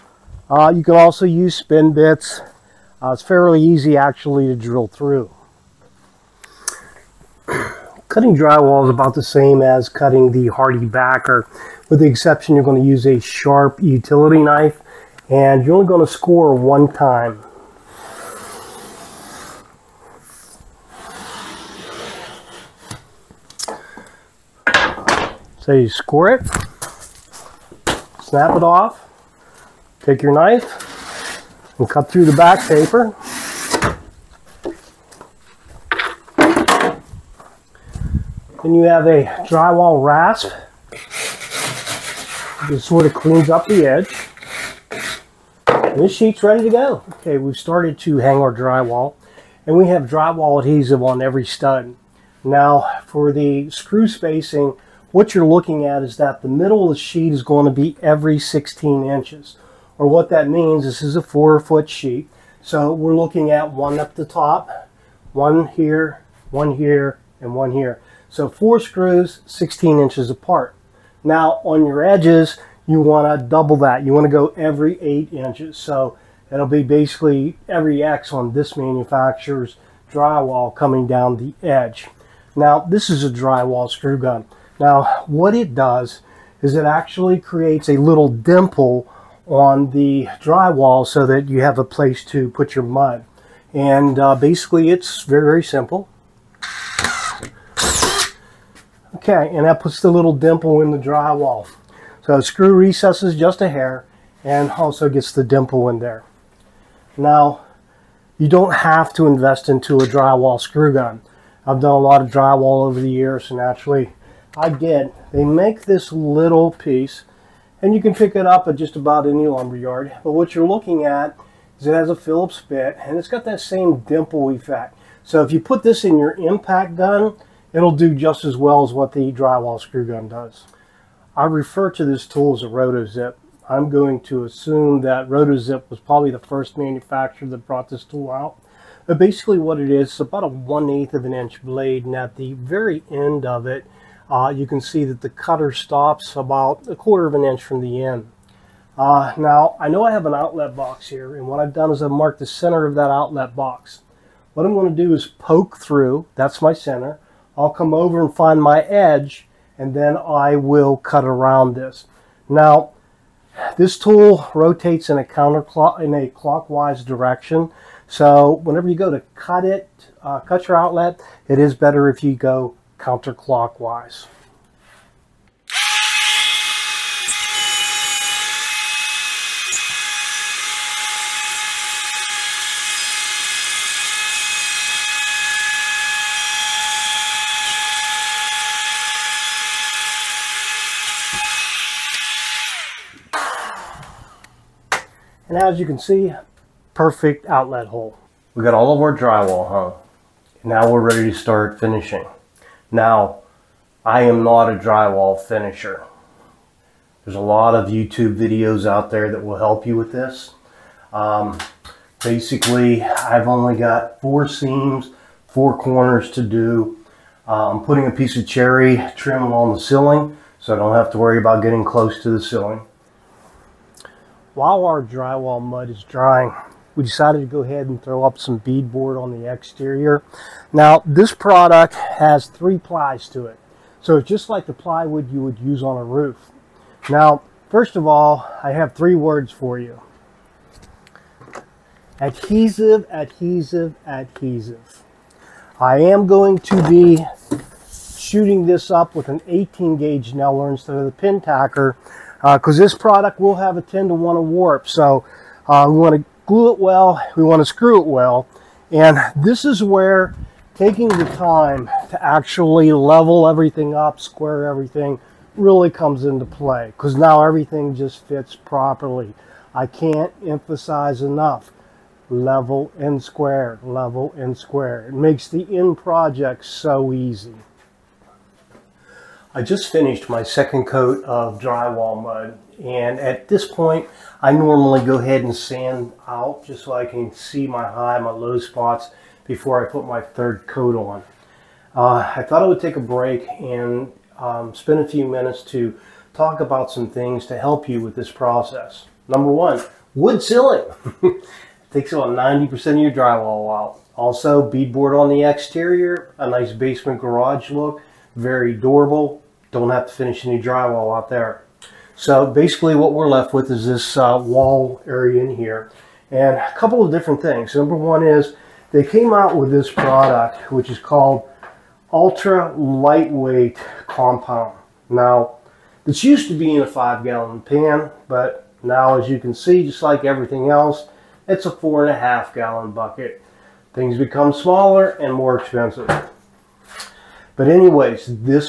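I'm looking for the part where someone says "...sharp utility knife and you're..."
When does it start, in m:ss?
0:13.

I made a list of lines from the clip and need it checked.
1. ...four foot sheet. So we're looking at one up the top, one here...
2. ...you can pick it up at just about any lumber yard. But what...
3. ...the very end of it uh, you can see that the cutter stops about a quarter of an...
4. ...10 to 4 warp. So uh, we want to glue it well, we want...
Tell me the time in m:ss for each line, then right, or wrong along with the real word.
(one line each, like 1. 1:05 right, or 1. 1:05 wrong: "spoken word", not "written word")
1. 1:01 right
2. 1:57 right
3. 2:22 right
4. 4:13 wrong: "1", not "4".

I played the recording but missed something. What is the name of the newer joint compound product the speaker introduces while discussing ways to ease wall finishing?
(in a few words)
Ultra Lightweight Compound.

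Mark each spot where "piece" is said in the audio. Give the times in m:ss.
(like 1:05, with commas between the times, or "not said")
1:56, 3:38.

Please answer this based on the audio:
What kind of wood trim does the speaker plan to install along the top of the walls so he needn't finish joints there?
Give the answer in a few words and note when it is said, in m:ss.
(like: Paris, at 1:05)
Cherry, at 3:38.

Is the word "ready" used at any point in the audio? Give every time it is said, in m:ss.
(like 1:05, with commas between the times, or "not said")
0:46, 3:21.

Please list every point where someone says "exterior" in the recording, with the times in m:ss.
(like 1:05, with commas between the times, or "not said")
3:49, 5:05.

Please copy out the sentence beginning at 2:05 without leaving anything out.
So if you put this in your impact gun, it'll do just as well as what the drywall screw gun does.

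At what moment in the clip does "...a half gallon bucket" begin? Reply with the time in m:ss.
5:32.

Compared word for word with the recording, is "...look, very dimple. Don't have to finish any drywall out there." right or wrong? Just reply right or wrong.
wrong.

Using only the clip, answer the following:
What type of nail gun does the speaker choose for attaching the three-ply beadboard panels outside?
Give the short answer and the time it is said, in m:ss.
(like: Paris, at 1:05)
18 gauge nailer, at 4:09.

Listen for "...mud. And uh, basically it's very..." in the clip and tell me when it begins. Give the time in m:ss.
1:32.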